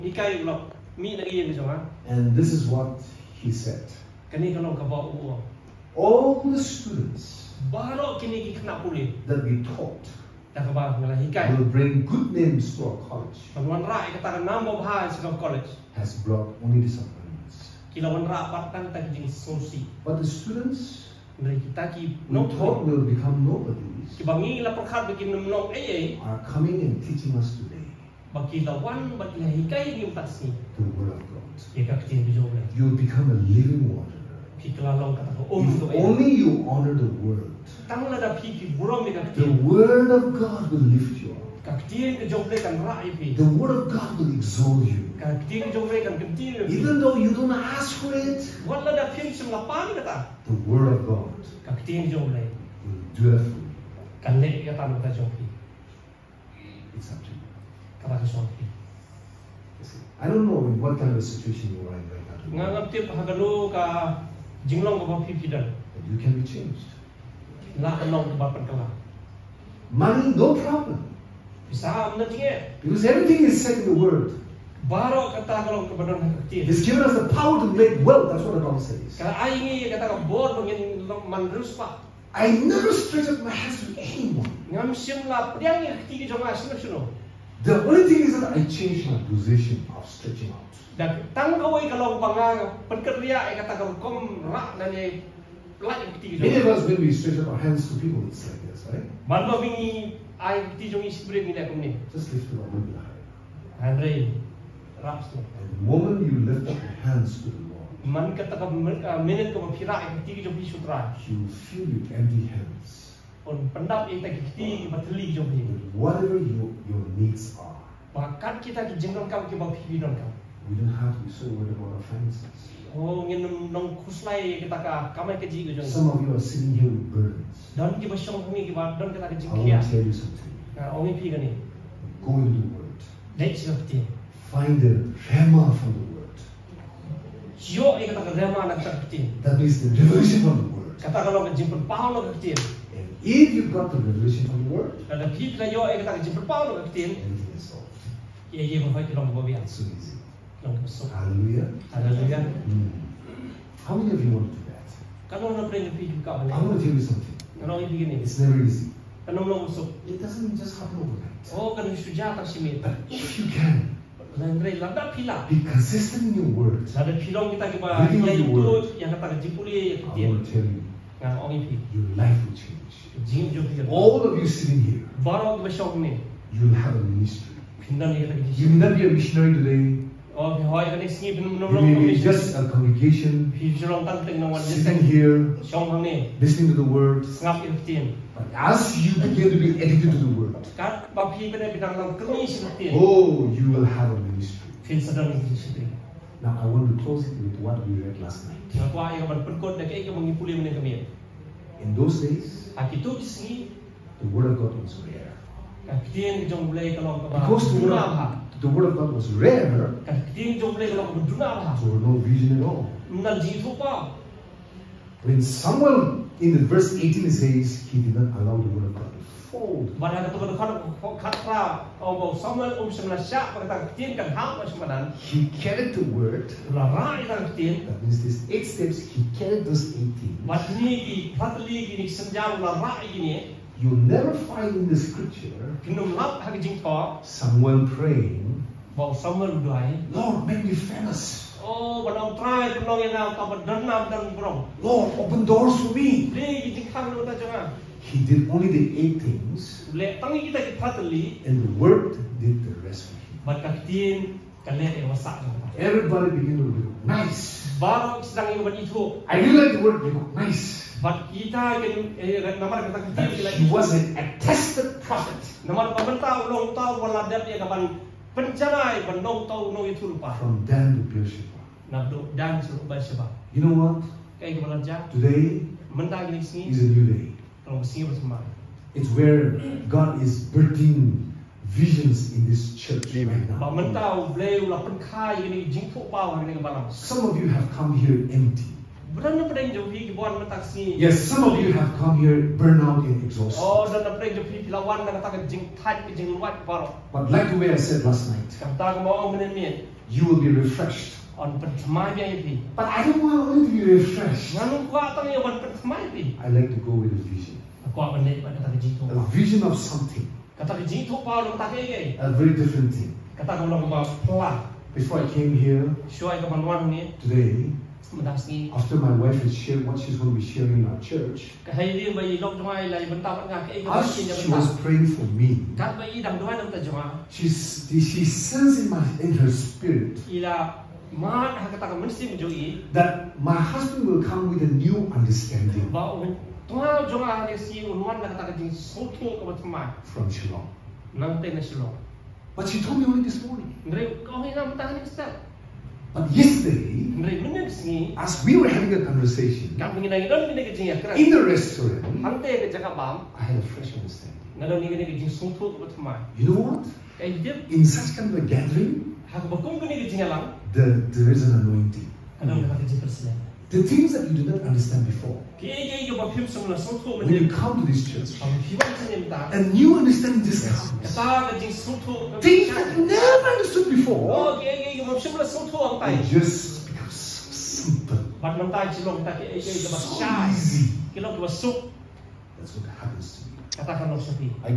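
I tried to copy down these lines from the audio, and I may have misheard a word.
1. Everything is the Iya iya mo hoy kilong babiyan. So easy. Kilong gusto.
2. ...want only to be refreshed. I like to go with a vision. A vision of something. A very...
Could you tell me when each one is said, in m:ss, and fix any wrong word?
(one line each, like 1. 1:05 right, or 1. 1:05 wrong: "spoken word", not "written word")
1. 2:27 right
2. 5:03 right.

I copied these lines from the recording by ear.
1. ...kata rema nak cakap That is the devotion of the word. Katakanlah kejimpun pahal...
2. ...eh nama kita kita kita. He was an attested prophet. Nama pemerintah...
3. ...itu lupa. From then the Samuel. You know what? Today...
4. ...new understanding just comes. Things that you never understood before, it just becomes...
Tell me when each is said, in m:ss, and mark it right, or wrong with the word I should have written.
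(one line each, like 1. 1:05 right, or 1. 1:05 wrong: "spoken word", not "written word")
1. 2:18 right
2. 4:22 right
3. 4:29 wrong: "Beersheba", not "Samuel"
4. 6:09 right.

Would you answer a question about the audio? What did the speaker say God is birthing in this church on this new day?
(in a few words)
visions.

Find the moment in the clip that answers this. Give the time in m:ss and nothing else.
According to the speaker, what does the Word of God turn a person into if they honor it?
0:33.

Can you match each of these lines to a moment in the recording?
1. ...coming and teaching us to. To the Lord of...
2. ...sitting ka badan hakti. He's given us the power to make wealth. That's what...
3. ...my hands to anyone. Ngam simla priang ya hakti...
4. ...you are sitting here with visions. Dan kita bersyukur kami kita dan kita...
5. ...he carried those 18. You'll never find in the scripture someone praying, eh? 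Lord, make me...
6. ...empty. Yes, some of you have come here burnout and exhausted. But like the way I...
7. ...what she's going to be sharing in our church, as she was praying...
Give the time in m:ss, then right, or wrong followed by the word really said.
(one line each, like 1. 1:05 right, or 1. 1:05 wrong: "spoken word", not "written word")
1. 0:26 wrong: "Word", not "Lord"
2. 1:15 wrong: "kalong", not "sitting"
3. 1:23 right
4. 2:06 wrong: "burdens", not "visions"
5. 3:49 right
6. 4:48 right
7. 5:19 right.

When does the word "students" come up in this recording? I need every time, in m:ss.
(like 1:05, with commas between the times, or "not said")
0:06, 0:20.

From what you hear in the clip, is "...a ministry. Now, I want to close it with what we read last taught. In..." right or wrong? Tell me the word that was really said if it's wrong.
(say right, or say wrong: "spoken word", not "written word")
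wrong: "night", not "taught".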